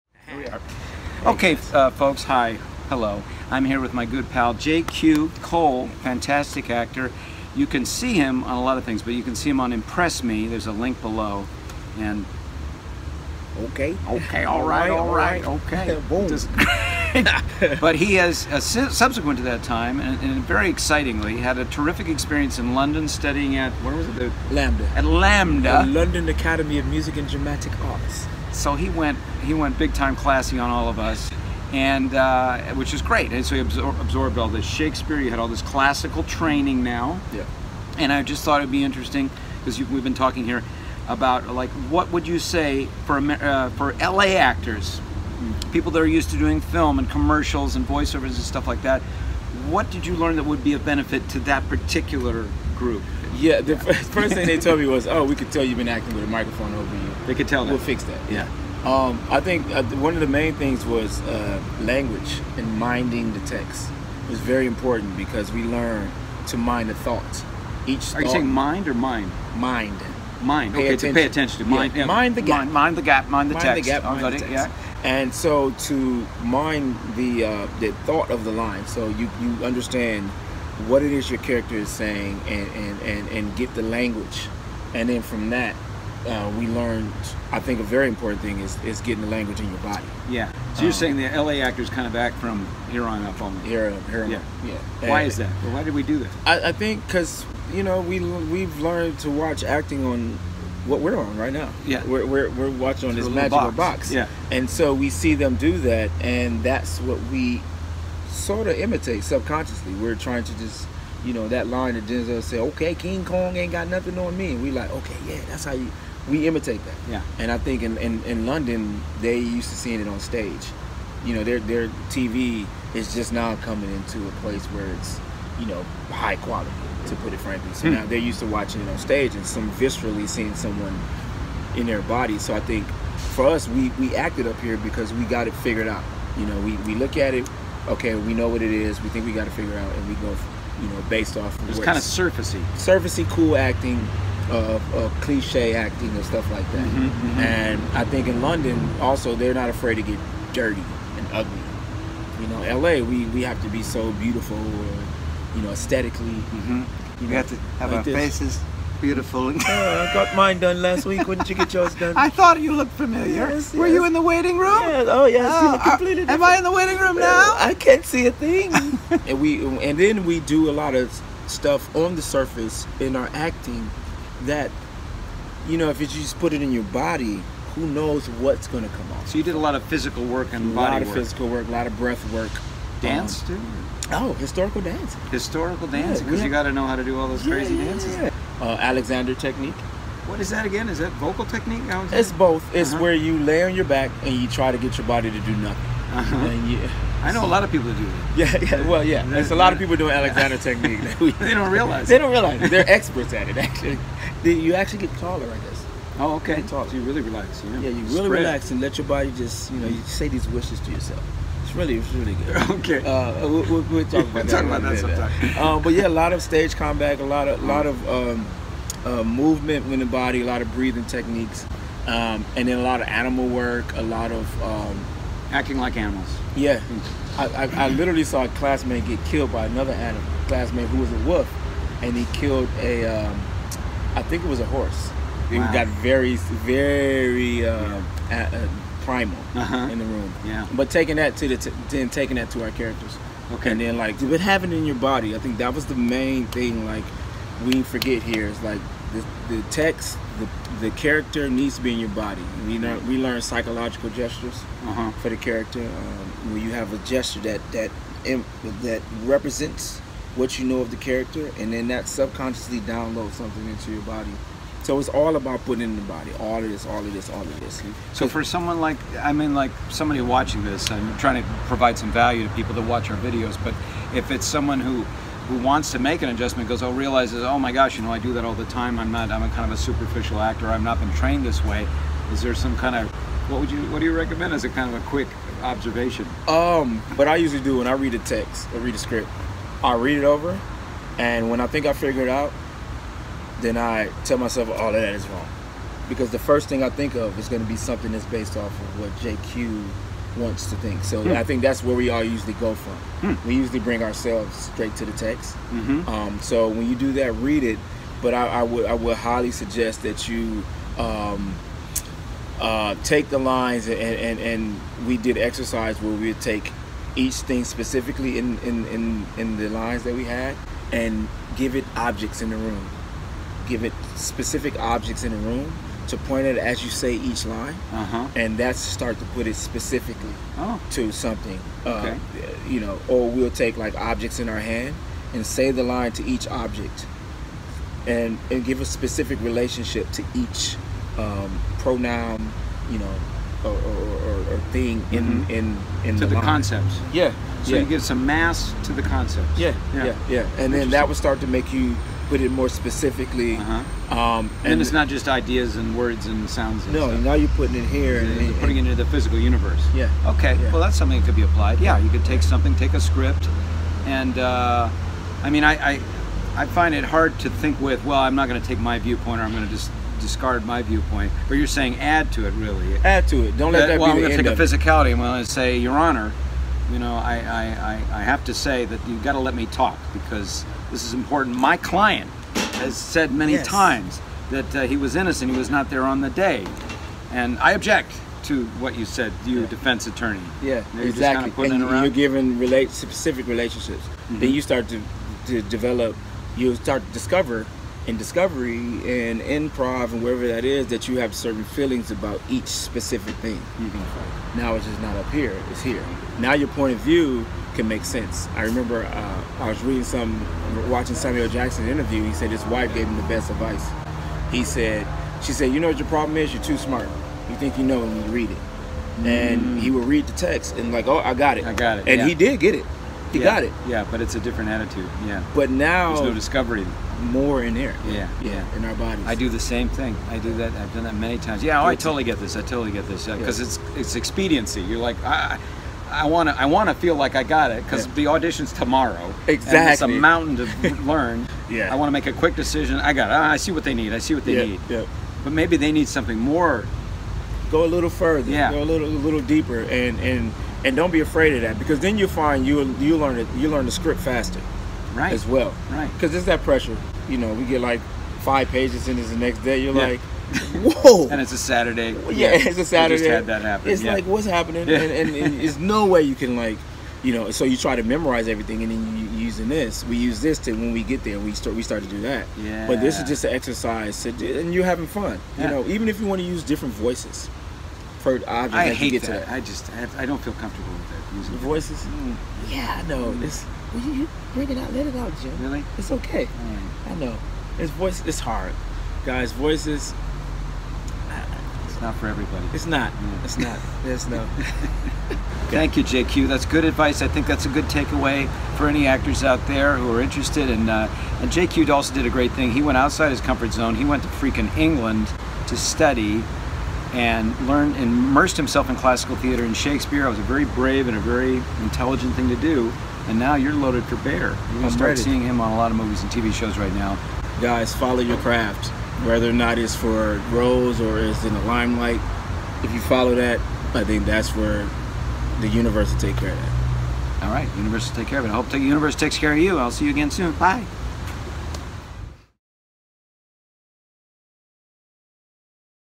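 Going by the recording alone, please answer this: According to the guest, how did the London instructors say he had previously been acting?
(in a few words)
With a microphone over you.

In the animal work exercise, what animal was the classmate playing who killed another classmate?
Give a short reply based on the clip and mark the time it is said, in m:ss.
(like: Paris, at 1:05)
A wolf, at 3:51.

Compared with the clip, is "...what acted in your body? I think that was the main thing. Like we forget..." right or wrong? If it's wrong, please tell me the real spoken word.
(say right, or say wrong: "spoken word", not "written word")
wrong: "happened", not "acted".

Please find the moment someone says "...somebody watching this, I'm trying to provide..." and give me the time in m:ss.
4:29.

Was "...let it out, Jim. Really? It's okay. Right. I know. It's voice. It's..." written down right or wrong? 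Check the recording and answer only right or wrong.
right.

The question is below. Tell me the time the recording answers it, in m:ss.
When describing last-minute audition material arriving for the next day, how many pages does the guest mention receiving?
7:38.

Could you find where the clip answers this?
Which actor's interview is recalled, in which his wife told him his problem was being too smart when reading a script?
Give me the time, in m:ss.
6:51.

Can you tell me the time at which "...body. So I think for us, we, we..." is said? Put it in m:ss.
2:12.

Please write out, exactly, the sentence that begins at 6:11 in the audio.
But you're saying add to it, really.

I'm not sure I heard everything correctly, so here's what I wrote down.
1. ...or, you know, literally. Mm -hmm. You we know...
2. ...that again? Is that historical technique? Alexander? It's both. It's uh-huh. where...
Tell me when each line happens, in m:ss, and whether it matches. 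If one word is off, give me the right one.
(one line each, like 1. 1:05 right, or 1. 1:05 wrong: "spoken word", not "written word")
1. 2:34 wrong: "aesthetically", not "literally"
2. 3:10 wrong: "vocal", not "historical".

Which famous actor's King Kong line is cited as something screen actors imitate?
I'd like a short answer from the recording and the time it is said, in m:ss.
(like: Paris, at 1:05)
Denzel, at 1:52.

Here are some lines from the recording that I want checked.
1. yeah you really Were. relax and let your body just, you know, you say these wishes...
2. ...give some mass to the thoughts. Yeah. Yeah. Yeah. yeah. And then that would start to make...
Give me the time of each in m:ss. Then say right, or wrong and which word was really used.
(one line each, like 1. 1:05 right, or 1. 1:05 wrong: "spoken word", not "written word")
1. 3:27 wrong: "Spread", not "Were"
2. 5:47 wrong: "concepts", not "thoughts".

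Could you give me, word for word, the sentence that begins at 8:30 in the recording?
I was a very brave and a very intelligent thing to do.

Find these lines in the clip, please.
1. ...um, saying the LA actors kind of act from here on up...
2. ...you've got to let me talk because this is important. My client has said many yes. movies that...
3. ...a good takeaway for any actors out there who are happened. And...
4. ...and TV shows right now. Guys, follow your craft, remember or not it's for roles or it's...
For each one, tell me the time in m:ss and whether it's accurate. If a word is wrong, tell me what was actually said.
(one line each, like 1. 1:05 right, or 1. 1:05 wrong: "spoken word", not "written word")
1. 1:30 right
2. 6:19 wrong: "times", not "movies"
3. 8:17 wrong: "interested", not "happened"
4. 8:36 wrong: "whether", not "remember".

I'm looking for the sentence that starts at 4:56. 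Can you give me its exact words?
Because the first thing I think of is going to be something that's based off of what JQ wants to think.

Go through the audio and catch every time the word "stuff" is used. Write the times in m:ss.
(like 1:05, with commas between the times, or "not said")
0:48, 2:26, 2:51, 5:57.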